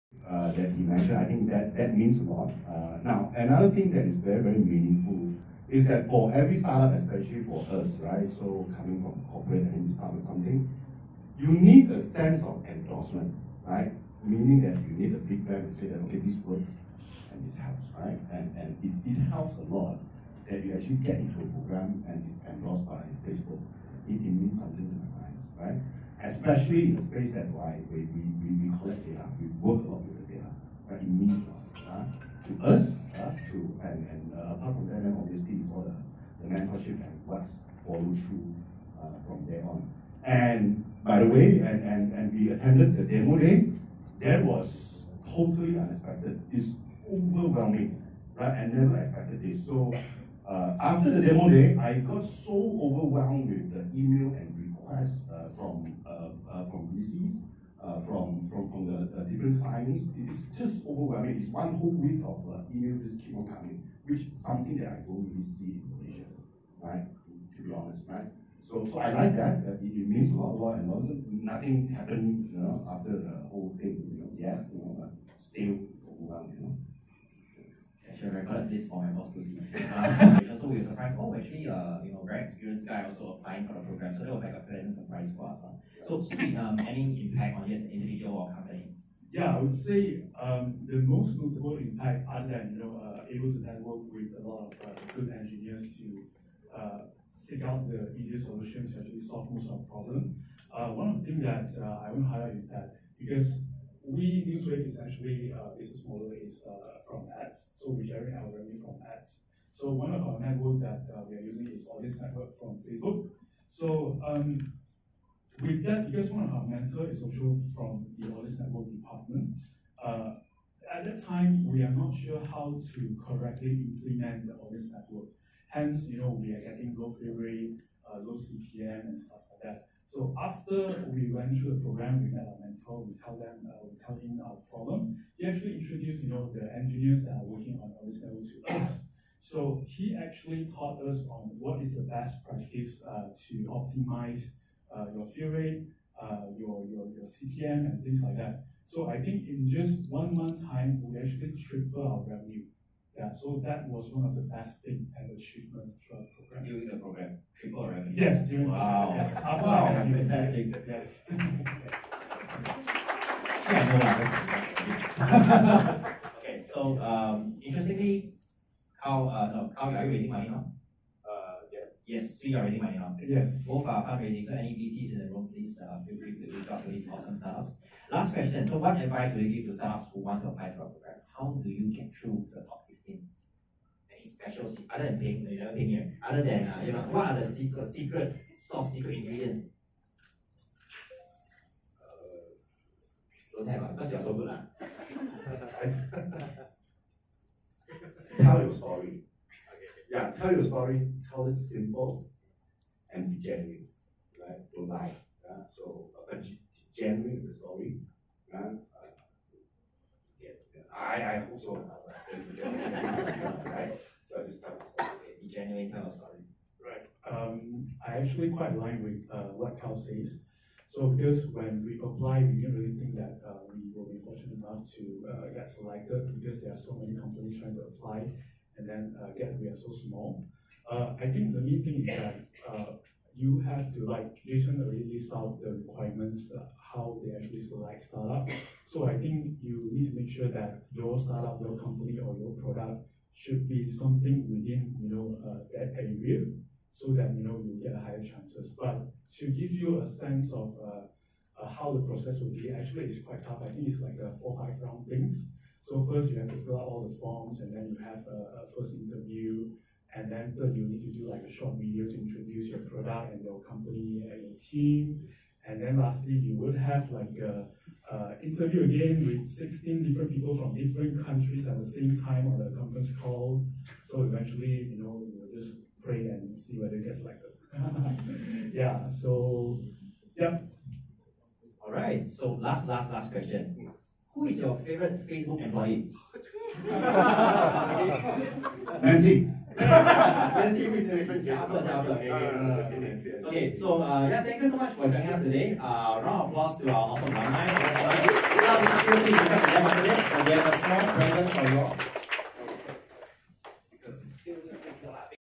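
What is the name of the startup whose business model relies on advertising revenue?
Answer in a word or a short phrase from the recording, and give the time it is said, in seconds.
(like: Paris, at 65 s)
Newswave, at 104 s.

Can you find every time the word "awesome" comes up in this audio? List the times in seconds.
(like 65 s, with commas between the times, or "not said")
177 s, 297 s.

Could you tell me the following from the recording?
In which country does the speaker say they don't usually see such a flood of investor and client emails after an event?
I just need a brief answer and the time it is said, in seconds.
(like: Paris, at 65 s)
Malaysia, at 65 s.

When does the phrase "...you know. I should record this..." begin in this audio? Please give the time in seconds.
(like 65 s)
76 s.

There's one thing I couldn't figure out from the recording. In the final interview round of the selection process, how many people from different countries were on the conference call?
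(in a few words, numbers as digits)
16.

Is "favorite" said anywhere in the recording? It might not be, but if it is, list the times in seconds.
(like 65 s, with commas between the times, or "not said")
284 s, 291 s.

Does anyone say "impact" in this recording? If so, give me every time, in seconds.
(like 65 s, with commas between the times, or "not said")
87 s, 91 s.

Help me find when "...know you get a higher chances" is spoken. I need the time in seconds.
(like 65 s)
247 s.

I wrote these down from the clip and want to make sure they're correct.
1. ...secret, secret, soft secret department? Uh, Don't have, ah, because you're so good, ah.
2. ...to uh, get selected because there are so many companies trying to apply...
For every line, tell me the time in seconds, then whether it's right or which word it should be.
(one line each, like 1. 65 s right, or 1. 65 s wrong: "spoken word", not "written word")
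1. 187 s wrong: "ingredient", not "department"
2. 224 s right.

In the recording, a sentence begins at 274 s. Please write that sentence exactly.
So eventually you know you just pray and see whether it gets elected.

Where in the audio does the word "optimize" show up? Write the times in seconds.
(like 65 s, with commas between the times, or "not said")
143 s.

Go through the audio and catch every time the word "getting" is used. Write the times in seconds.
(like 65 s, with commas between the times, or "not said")
126 s.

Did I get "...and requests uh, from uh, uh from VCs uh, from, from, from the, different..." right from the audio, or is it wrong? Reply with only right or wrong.
right.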